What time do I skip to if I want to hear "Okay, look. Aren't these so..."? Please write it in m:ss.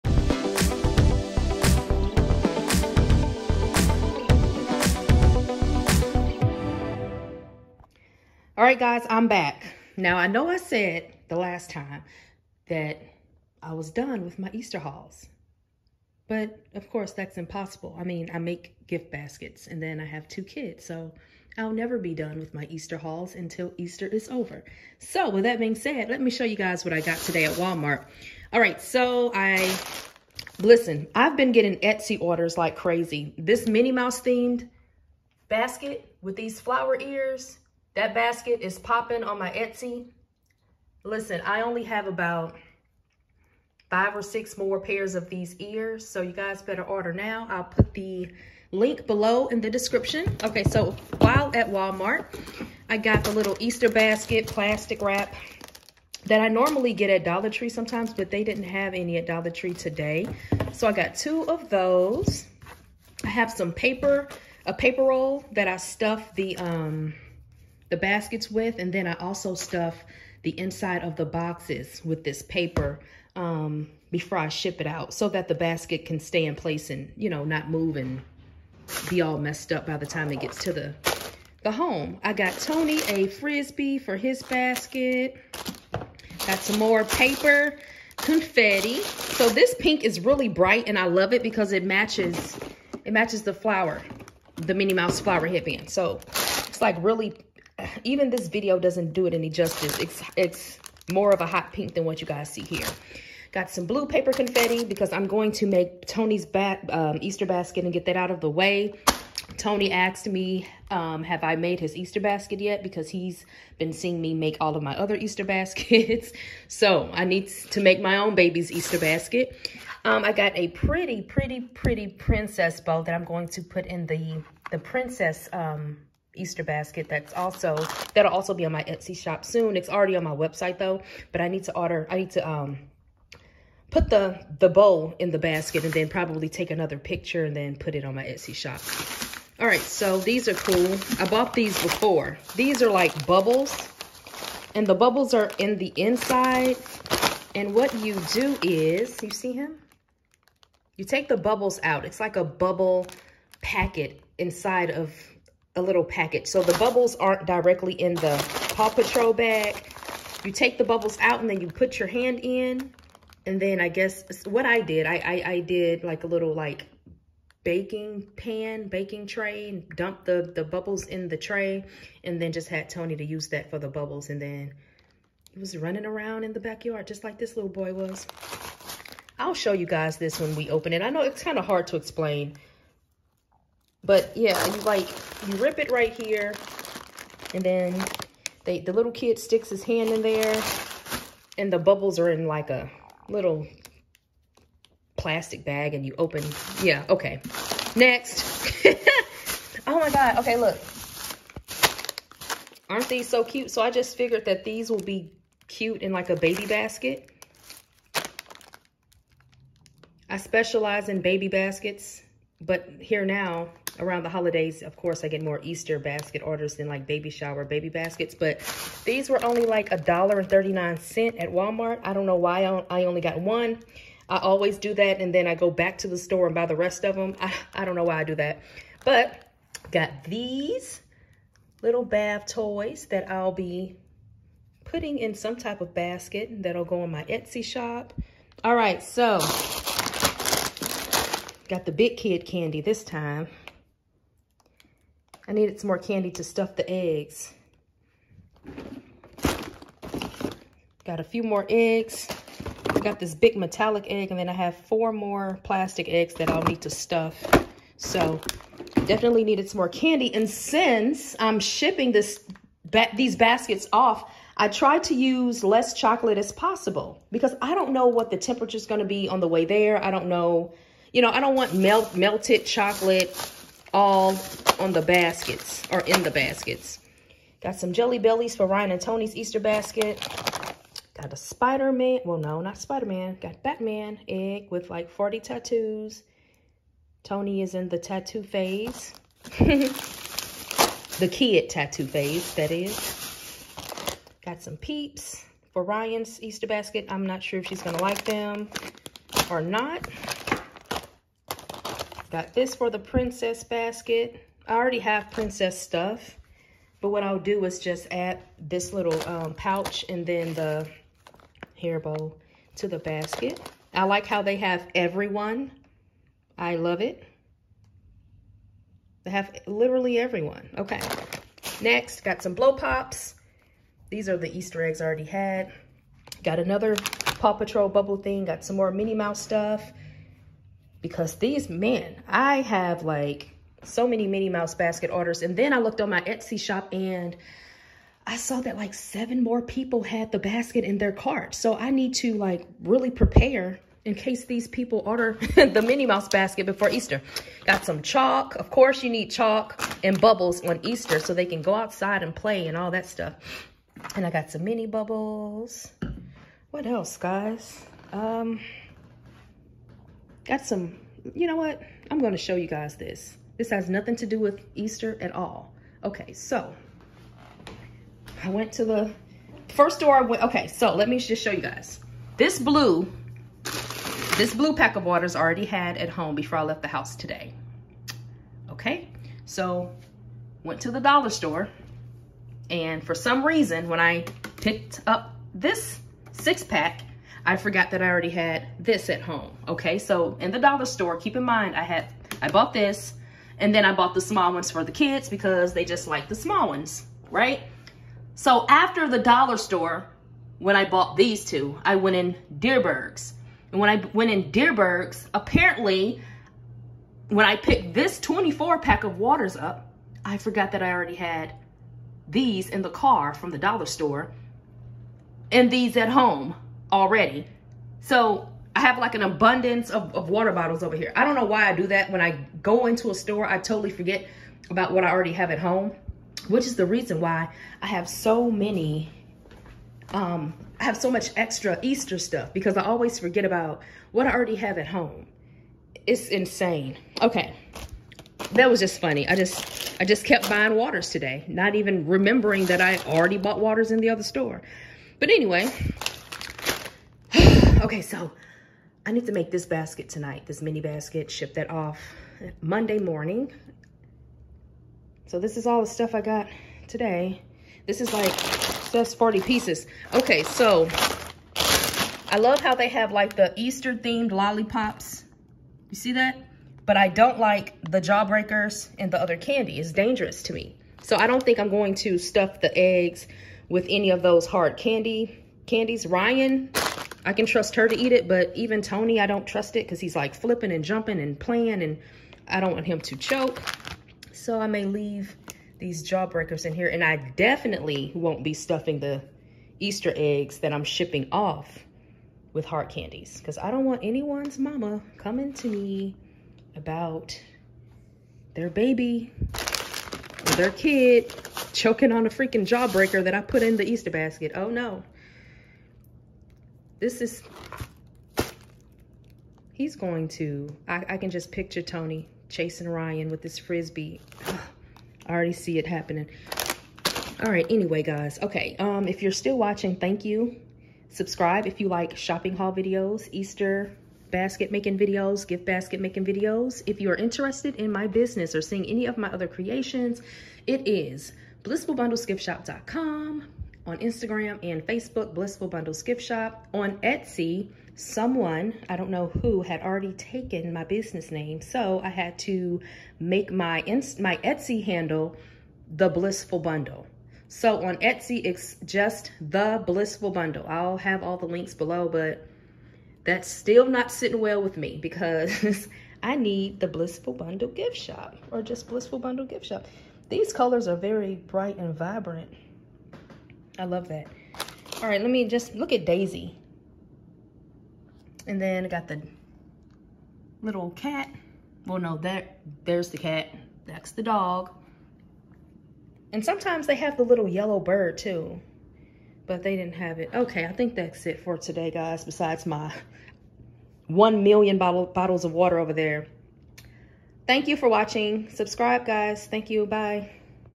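3:20.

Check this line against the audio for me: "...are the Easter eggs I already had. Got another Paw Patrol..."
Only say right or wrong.
right.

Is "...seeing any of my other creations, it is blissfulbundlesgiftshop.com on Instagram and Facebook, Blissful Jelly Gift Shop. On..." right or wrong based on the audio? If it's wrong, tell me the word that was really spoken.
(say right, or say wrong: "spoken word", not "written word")
wrong: "Bundles", not "Jelly".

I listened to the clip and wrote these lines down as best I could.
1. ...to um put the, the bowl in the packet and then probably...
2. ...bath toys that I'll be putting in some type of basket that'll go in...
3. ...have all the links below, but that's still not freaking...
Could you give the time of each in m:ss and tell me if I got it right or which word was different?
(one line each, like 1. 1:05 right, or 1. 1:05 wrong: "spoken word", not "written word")
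1. 2:12 wrong: "basket", not "packet"
2. 3:52 right
3. 9:10 wrong: "sitting", not "freaking".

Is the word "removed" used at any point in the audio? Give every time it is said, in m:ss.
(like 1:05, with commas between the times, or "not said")
not said.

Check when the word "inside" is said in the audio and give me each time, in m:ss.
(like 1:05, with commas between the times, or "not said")
1:10, 2:25, 2:34.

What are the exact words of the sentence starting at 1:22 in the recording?
I got Tony a Frisbee for his basket.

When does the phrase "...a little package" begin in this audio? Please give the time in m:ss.
2:35.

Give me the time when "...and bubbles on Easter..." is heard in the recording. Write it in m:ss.
5:50.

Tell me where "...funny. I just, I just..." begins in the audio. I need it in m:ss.
7:18.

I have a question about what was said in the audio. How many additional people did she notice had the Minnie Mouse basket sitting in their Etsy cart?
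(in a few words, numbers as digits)
7.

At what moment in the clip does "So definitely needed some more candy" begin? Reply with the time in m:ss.
4:17.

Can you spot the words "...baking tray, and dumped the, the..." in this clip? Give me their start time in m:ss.
2:48.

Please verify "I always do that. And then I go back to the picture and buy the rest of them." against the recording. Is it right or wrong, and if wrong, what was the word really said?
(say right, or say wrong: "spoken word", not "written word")
wrong: "store", not "picture".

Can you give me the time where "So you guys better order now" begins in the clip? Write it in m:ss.
0:46.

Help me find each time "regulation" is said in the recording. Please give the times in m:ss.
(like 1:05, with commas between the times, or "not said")
not said.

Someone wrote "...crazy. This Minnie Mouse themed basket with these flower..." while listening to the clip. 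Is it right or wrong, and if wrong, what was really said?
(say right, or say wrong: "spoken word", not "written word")
right.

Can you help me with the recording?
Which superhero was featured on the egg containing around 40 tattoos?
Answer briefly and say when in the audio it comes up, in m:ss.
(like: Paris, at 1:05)
Batman, at 4:43.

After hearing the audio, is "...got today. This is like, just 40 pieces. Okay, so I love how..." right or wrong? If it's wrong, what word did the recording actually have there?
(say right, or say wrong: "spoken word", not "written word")
right.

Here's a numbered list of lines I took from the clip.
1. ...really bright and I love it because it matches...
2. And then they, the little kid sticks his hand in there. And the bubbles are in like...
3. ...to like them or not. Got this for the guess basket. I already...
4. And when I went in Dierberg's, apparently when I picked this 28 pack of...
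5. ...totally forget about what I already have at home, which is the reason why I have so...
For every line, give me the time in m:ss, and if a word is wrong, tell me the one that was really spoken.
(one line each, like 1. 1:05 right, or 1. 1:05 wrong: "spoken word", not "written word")
1. 1:30 right
2. 3:07 right
3. 4:57 wrong: "princess", not "guess"
4. 6:43 wrong: "24", not "28"
5. 7:03 right.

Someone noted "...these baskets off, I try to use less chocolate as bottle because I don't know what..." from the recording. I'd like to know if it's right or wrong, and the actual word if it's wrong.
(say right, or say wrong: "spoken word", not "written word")
wrong: "possible", not "bottle".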